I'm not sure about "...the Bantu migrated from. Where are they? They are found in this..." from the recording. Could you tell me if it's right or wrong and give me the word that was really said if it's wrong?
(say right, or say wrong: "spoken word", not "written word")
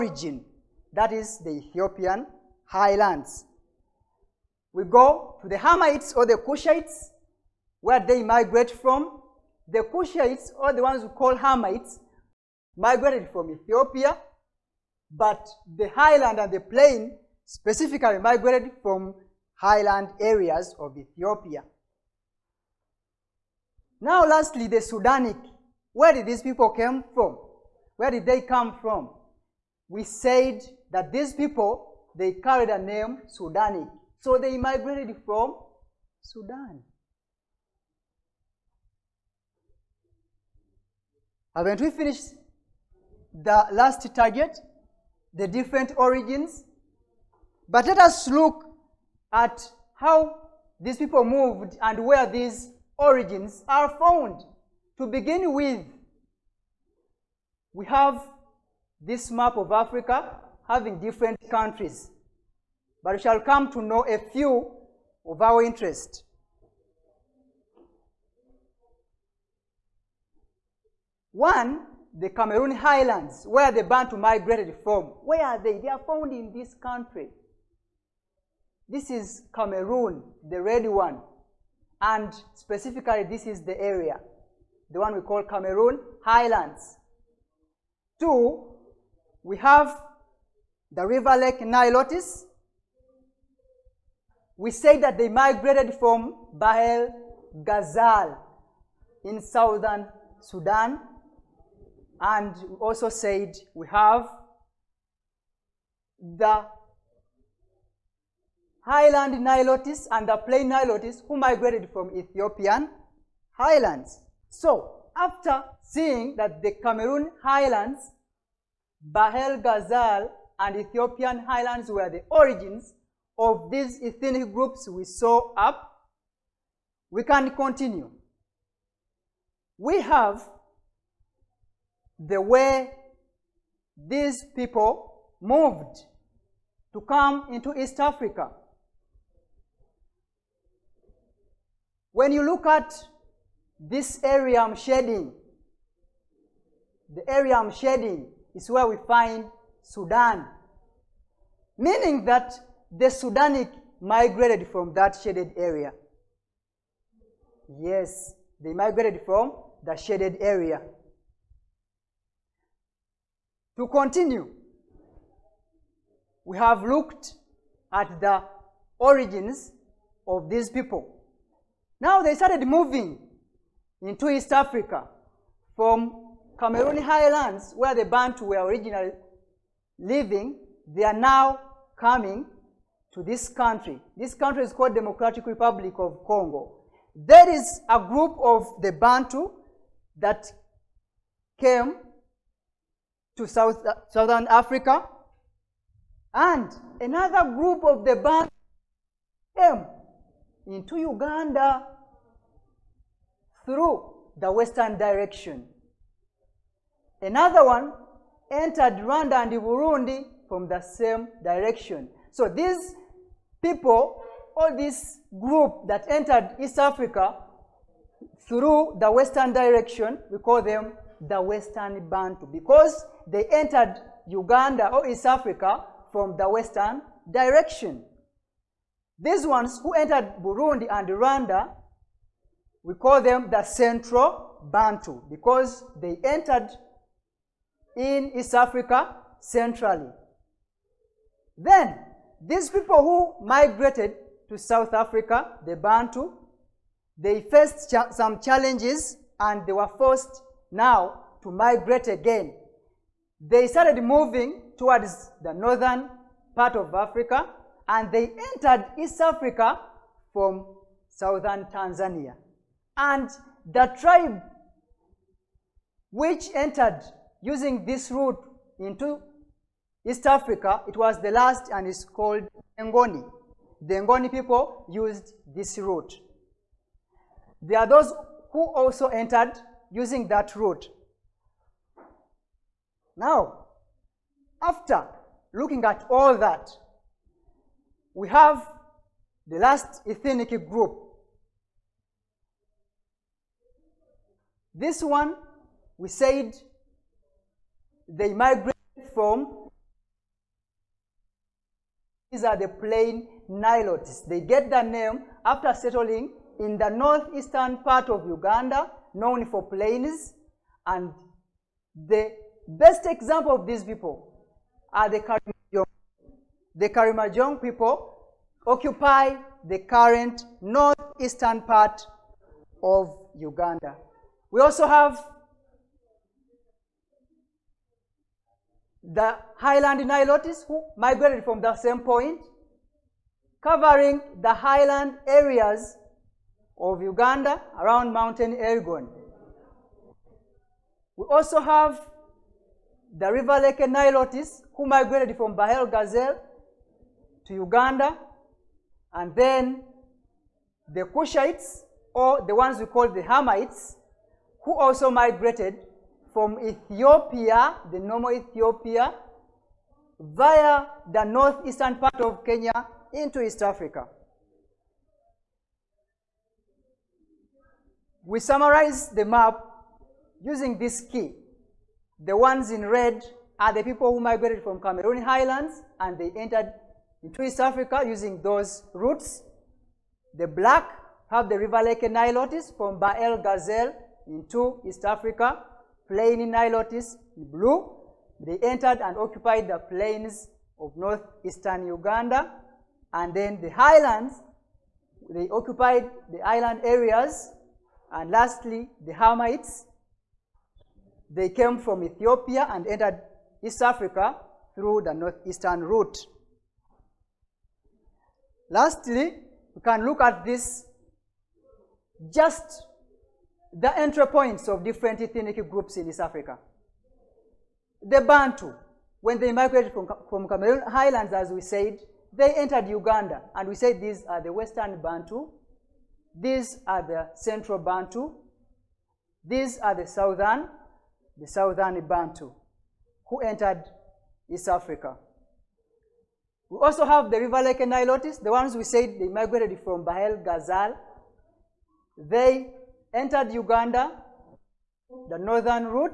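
right.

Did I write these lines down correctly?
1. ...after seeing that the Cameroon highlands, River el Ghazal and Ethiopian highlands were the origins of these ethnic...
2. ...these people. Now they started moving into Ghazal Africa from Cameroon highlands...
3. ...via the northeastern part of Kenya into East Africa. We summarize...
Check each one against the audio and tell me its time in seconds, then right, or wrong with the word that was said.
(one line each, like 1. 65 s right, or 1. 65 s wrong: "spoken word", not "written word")
1. 115 s wrong: "Bahr", not "River"
2. 170 s wrong: "East", not "Ghazal"
3. 360 s right.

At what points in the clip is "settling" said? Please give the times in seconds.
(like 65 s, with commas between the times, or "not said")
305 s.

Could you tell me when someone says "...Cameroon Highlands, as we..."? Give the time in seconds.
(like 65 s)
420 s.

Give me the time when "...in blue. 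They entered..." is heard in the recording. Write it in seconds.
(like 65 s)
387 s.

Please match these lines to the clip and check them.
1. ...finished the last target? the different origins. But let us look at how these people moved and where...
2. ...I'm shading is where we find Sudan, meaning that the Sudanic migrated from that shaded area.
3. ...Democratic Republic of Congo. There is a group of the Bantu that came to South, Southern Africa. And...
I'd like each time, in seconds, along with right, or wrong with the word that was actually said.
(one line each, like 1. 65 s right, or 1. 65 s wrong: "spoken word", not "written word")
1. 41 s right
2. 147 s right
3. 184 s right.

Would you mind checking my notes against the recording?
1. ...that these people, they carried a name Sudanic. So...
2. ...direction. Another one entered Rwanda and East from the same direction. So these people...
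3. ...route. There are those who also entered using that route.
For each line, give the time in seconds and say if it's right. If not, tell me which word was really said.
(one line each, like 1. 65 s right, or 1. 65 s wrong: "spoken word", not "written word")
1. 30 s right
2. 204 s wrong: "Burundi", not "East"
3. 275 s right.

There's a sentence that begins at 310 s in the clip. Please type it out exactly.
And the best example of these people are the Karimojong.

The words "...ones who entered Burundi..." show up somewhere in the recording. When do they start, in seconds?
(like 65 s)
229 s.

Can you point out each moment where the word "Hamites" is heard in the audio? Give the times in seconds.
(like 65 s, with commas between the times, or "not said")
5 s, 11 s, 353 s, 399 s.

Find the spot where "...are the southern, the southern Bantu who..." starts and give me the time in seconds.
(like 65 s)
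429 s.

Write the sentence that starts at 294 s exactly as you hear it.
This one, we said they migrated from, these are the plain Nilotes.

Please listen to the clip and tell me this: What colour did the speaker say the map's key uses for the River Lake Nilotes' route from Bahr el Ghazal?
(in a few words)
Black.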